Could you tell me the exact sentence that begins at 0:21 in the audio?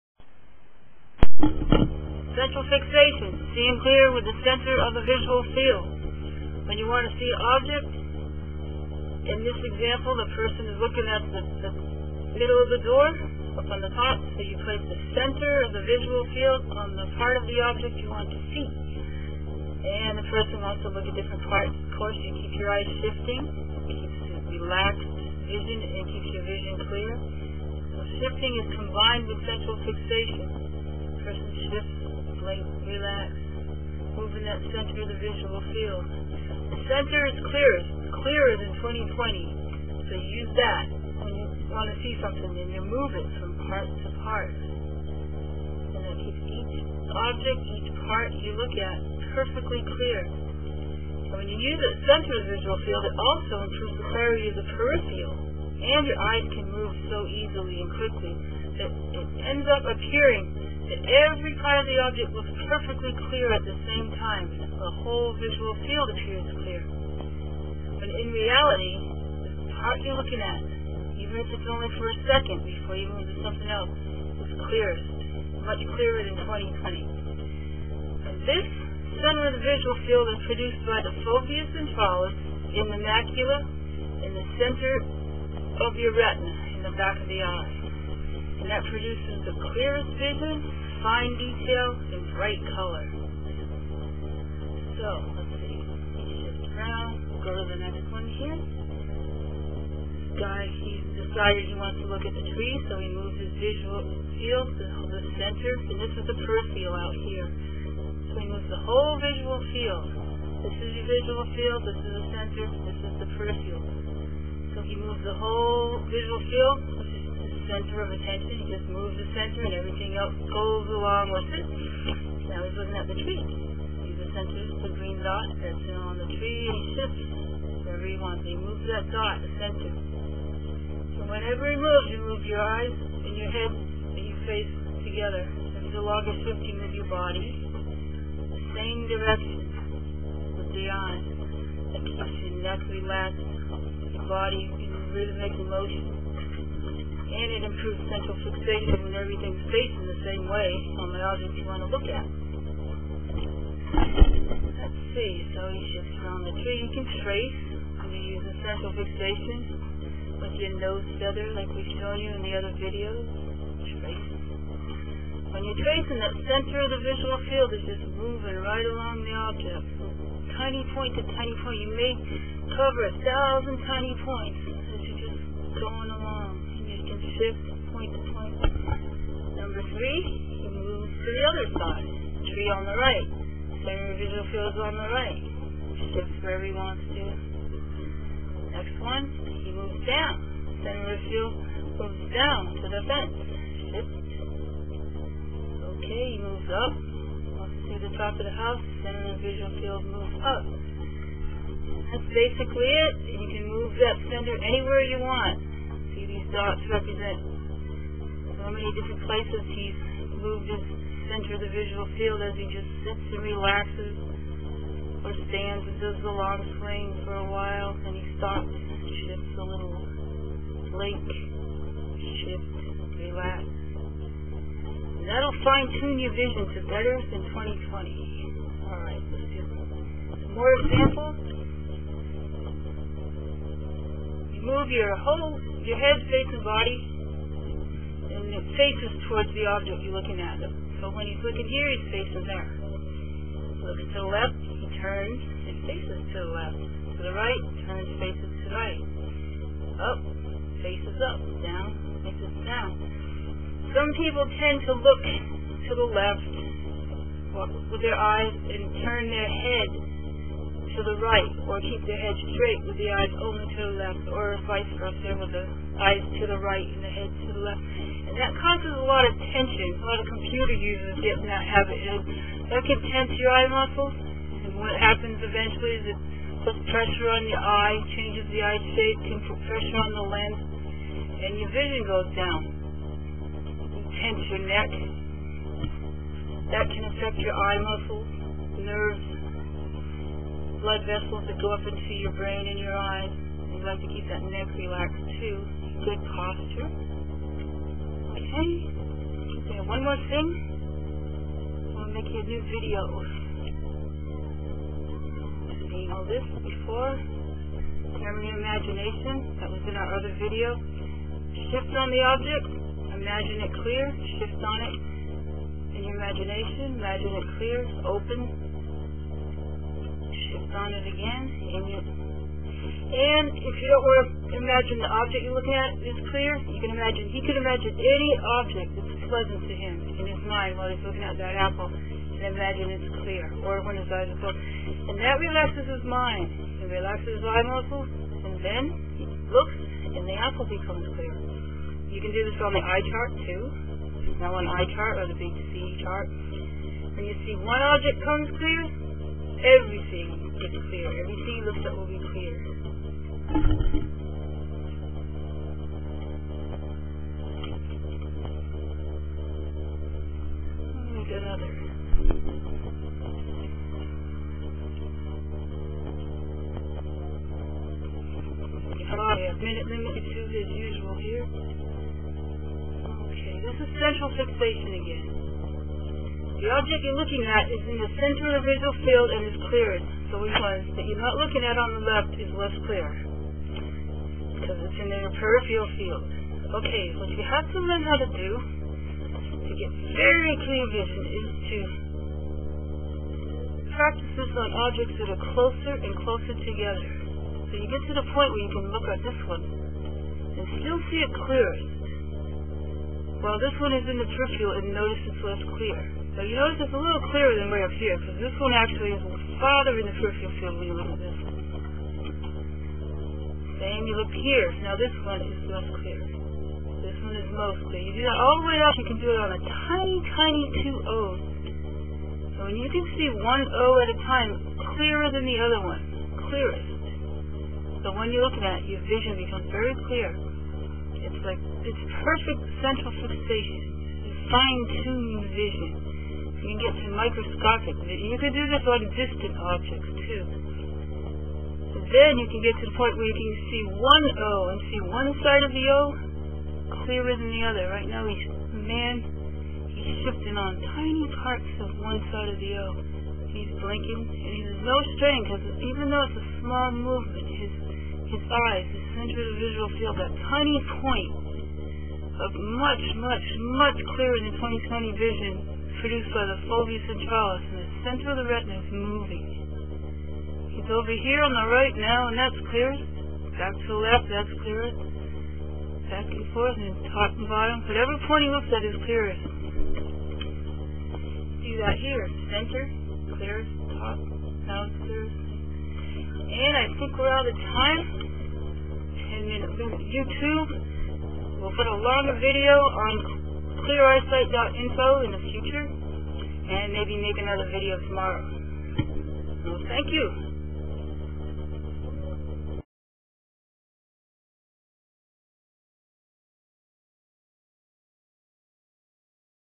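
Of course, you keep your eyes shifting, keeps relaxed vision, and keeps your vision clear.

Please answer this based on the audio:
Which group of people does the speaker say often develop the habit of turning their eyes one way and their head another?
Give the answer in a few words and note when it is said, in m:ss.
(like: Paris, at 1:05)
computer users, at 4:30.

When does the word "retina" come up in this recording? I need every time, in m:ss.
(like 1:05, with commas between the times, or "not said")
1:26, 7:48.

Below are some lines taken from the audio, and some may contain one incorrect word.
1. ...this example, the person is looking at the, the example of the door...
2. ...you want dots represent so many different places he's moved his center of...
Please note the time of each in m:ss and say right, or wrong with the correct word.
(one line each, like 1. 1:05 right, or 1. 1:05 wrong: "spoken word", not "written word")
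1. 0:09 wrong: "middle", not "example"
2. 3:25 right.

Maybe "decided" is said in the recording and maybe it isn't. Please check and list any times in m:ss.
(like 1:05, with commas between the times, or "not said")
1:41.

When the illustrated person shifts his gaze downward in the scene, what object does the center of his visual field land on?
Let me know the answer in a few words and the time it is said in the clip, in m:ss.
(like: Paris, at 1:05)
the fence, at 3:12.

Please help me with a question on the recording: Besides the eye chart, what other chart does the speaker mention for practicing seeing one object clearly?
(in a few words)
big C chart.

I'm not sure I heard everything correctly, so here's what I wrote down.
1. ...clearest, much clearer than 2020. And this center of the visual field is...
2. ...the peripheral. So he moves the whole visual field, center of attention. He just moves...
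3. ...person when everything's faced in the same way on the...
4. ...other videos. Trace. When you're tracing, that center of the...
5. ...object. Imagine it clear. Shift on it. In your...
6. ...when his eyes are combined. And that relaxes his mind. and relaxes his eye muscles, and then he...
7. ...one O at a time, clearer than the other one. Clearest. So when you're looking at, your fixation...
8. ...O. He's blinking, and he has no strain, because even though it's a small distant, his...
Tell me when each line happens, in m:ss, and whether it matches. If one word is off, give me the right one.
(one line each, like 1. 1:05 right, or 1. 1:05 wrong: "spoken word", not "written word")
1. 1:14 right
2. 1:53 right
3. 2:28 wrong: "fixation", not "person"
4. 2:42 right
5. 5:12 right
6. 5:33 wrong: "closed", not "combined"
7. 7:03 wrong: "vision", not "fixation"
8. 7:32 wrong: "movement", not "distant".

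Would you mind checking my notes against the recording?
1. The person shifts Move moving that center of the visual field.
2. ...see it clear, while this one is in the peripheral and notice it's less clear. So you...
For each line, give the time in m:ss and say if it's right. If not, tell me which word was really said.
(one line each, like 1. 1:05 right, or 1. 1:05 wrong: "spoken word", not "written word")
1. 0:31 right
2. 6:41 right.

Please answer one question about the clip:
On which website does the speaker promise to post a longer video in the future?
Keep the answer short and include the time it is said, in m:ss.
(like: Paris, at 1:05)
cleareyesight.info, at 8:13.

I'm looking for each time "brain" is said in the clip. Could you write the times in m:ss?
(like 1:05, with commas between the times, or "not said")
4:52.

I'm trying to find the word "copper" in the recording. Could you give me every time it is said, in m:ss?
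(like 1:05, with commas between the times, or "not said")
not said.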